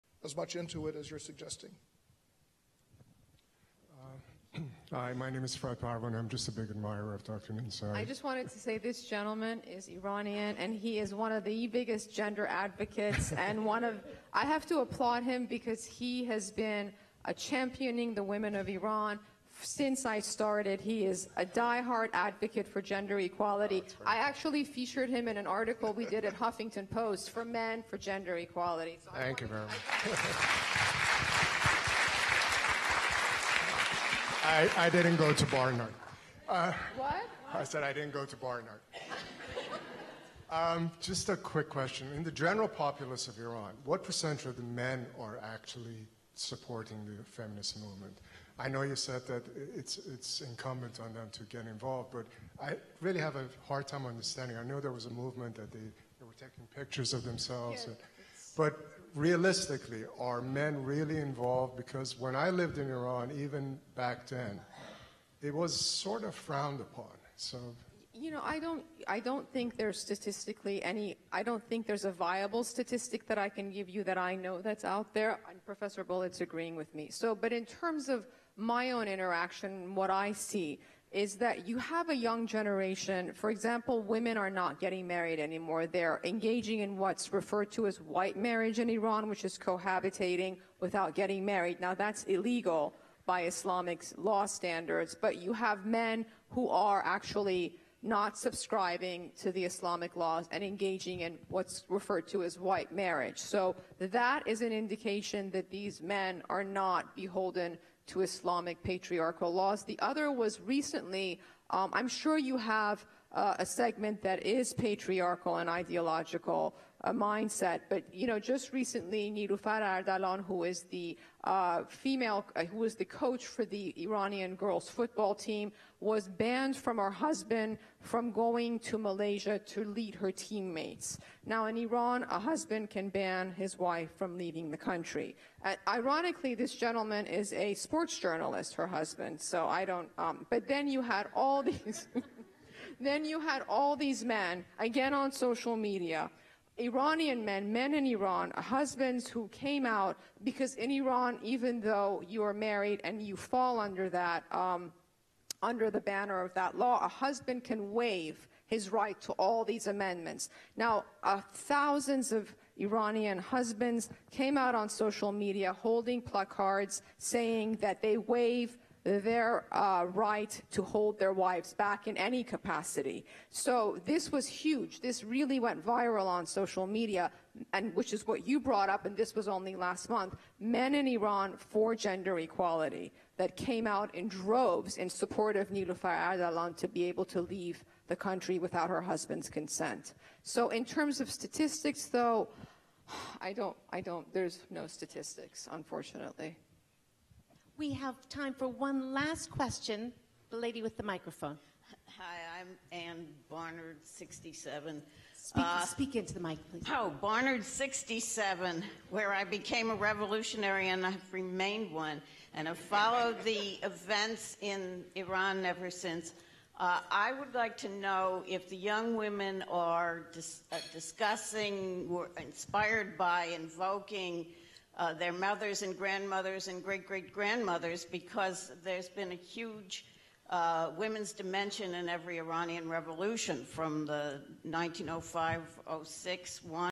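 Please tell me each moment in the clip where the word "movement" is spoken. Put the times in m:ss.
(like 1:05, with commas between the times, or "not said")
0:47, 0:55.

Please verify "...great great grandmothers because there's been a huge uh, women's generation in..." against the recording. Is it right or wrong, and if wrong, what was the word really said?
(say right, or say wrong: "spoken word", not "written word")
wrong: "dimension", not "generation".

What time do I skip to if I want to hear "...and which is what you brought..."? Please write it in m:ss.
2:57.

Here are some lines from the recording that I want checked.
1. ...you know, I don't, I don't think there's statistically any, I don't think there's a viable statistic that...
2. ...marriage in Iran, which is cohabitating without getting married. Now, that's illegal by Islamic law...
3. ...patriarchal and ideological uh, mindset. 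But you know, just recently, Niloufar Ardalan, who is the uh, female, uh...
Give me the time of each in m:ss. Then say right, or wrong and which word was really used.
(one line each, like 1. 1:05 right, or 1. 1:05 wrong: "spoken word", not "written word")
1. 1:08 right
2. 1:28 right
3. 1:54 right.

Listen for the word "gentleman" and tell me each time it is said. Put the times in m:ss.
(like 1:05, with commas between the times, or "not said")
0:09, 2:16.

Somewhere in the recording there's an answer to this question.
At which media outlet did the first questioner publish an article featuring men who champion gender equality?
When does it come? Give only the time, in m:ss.
0:26.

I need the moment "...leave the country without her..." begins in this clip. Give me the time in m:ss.
3:07.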